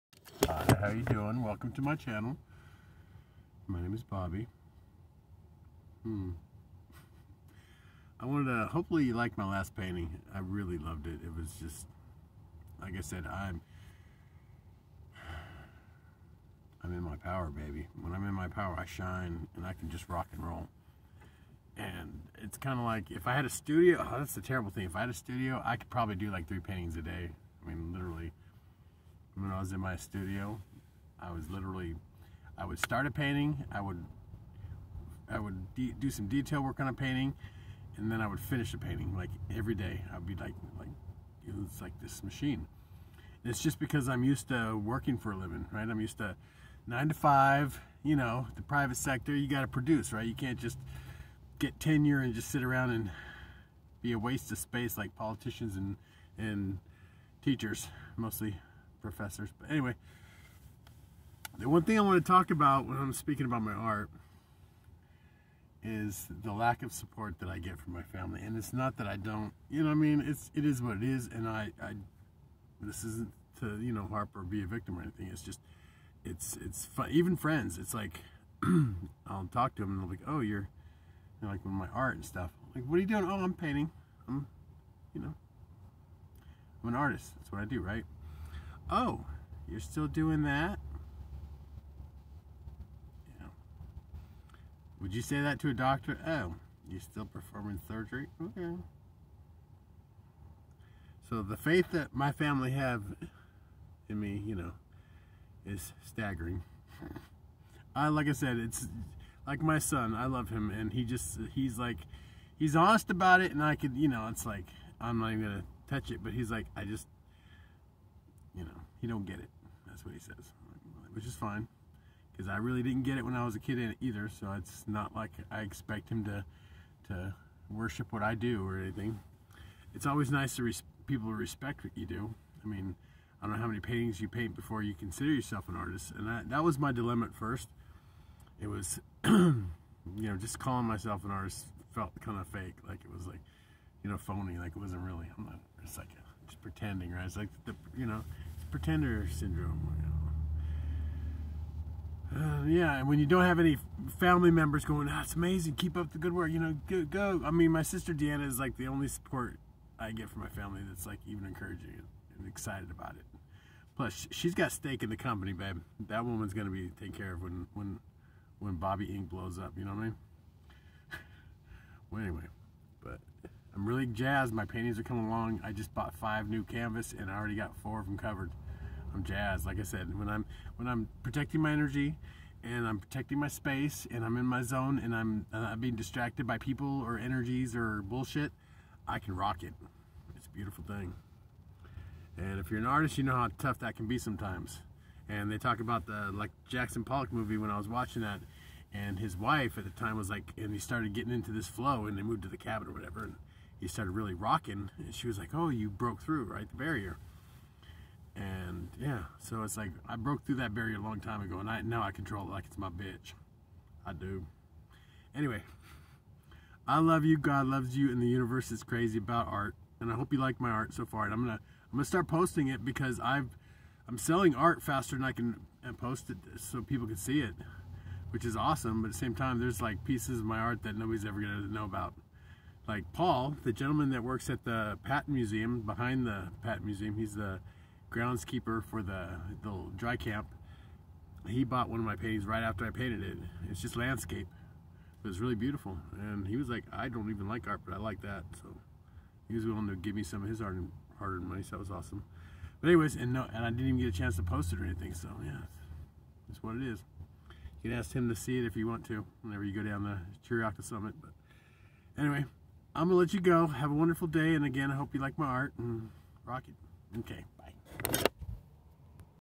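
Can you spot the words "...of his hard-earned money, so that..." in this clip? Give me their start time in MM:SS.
04:10.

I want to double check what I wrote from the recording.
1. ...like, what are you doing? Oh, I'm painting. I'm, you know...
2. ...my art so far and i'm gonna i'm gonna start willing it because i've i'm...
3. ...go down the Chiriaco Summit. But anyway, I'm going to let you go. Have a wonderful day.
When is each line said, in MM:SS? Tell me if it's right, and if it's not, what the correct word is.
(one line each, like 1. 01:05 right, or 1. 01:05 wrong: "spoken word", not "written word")
1. 01:22 right
2. 03:40 wrong: "posting", not "willing"
3. 04:19 right.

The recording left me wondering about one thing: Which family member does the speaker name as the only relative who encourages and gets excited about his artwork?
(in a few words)
Deanna.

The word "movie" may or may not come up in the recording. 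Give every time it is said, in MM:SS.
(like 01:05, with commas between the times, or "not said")
03:17.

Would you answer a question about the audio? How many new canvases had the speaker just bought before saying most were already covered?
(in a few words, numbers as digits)
5.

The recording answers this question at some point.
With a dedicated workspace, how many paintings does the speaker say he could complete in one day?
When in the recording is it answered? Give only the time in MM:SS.
00:26.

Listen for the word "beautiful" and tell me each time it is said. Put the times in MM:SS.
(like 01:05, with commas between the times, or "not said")
03:10, 04:05.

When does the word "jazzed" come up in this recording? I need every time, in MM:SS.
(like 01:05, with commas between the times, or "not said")
02:54, 02:59.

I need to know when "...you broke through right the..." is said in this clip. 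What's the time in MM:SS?
03:25.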